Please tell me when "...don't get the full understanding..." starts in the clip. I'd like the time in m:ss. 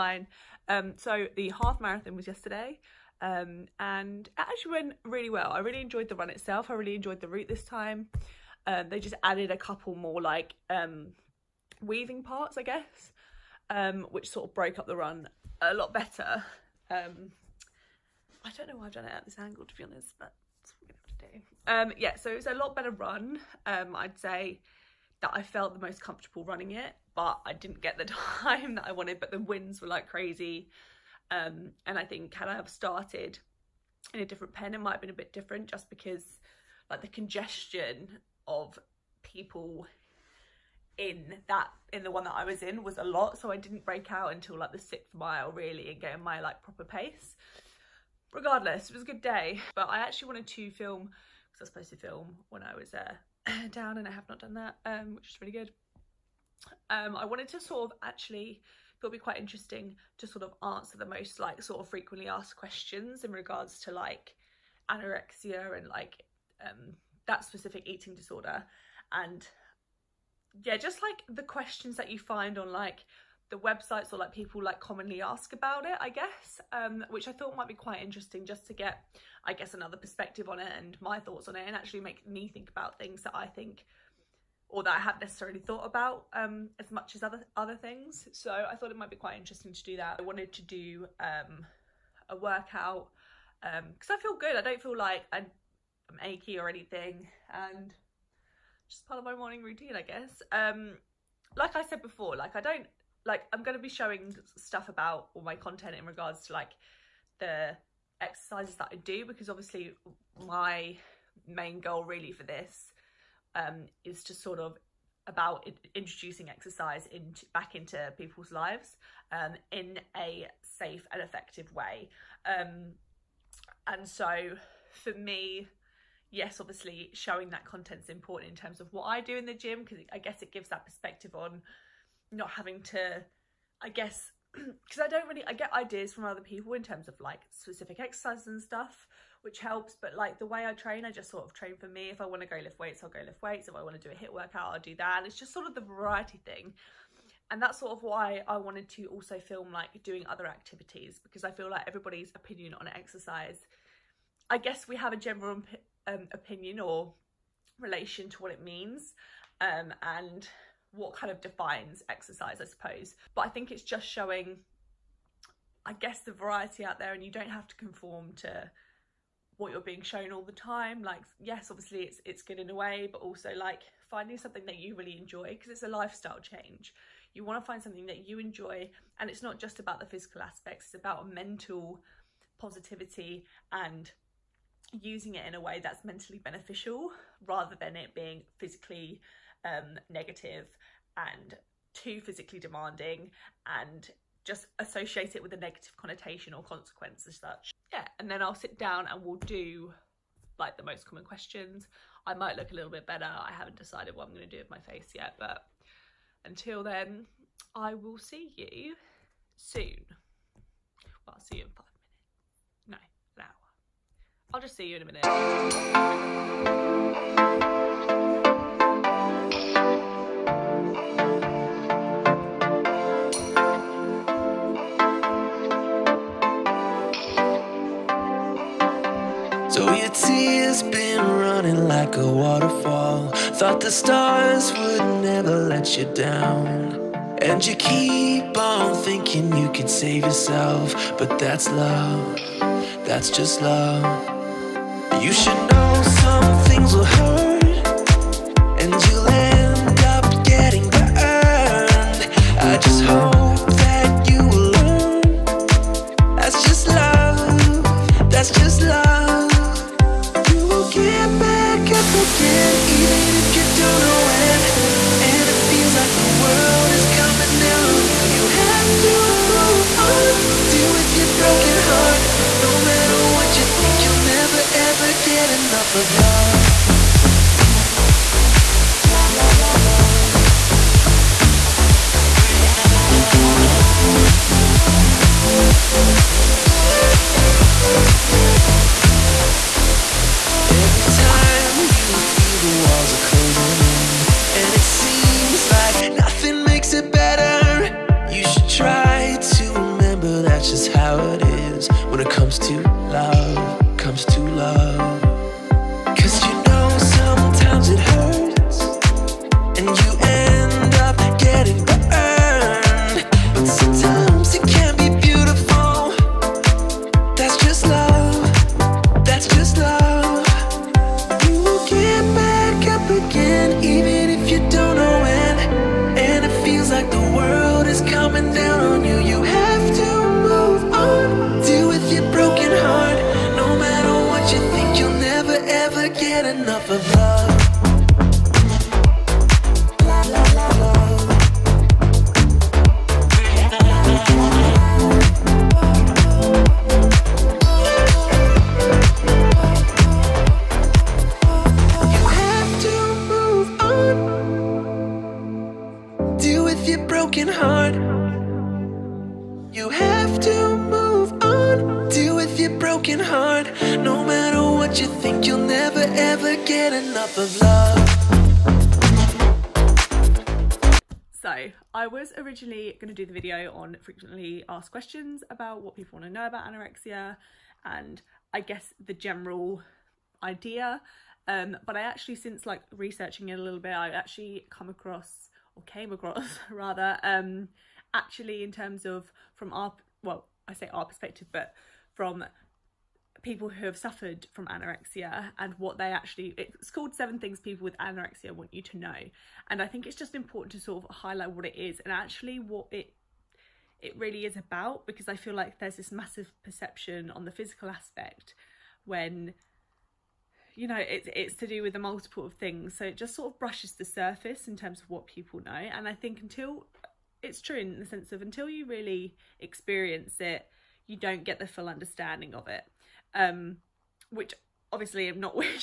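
7:01.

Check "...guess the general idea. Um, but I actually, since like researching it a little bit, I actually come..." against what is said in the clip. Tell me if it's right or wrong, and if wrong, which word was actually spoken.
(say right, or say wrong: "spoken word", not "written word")
right.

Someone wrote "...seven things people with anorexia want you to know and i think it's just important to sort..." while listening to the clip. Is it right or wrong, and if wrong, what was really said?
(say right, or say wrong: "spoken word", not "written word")
right.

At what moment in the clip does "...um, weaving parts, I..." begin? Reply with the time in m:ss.
0:10.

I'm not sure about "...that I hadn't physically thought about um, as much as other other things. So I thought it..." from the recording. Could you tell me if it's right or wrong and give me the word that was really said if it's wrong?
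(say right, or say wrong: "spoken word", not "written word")
wrong: "necessarily", not "physically".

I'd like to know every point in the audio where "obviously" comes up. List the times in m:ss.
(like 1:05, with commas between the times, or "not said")
1:49, 2:06, 2:51, 7:04.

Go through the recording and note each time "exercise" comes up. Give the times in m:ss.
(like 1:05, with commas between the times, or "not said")
1:48, 1:56, 2:17, 2:32, 2:42.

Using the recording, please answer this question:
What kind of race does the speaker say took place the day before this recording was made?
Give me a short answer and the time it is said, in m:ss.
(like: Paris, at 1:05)
Half marathon, at 0:01.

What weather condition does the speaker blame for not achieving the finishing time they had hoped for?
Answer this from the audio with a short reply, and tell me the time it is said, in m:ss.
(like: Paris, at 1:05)
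The winds, at 0:29.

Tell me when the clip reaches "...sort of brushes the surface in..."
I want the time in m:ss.
6:53.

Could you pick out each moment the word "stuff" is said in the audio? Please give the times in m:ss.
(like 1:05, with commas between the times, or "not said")
1:44, 2:18.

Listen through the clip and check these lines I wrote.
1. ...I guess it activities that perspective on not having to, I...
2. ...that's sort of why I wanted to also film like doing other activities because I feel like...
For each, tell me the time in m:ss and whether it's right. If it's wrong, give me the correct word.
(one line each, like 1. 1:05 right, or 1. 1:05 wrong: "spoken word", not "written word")
1. 2:10 wrong: "gives", not "activities"
2. 2:27 right.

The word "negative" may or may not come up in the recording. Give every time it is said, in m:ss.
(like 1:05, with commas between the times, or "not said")
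3:10, 3:15.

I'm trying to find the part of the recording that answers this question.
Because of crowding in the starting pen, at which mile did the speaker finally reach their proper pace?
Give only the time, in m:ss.
0:44.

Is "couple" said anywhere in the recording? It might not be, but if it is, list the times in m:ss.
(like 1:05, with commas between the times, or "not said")
0:09.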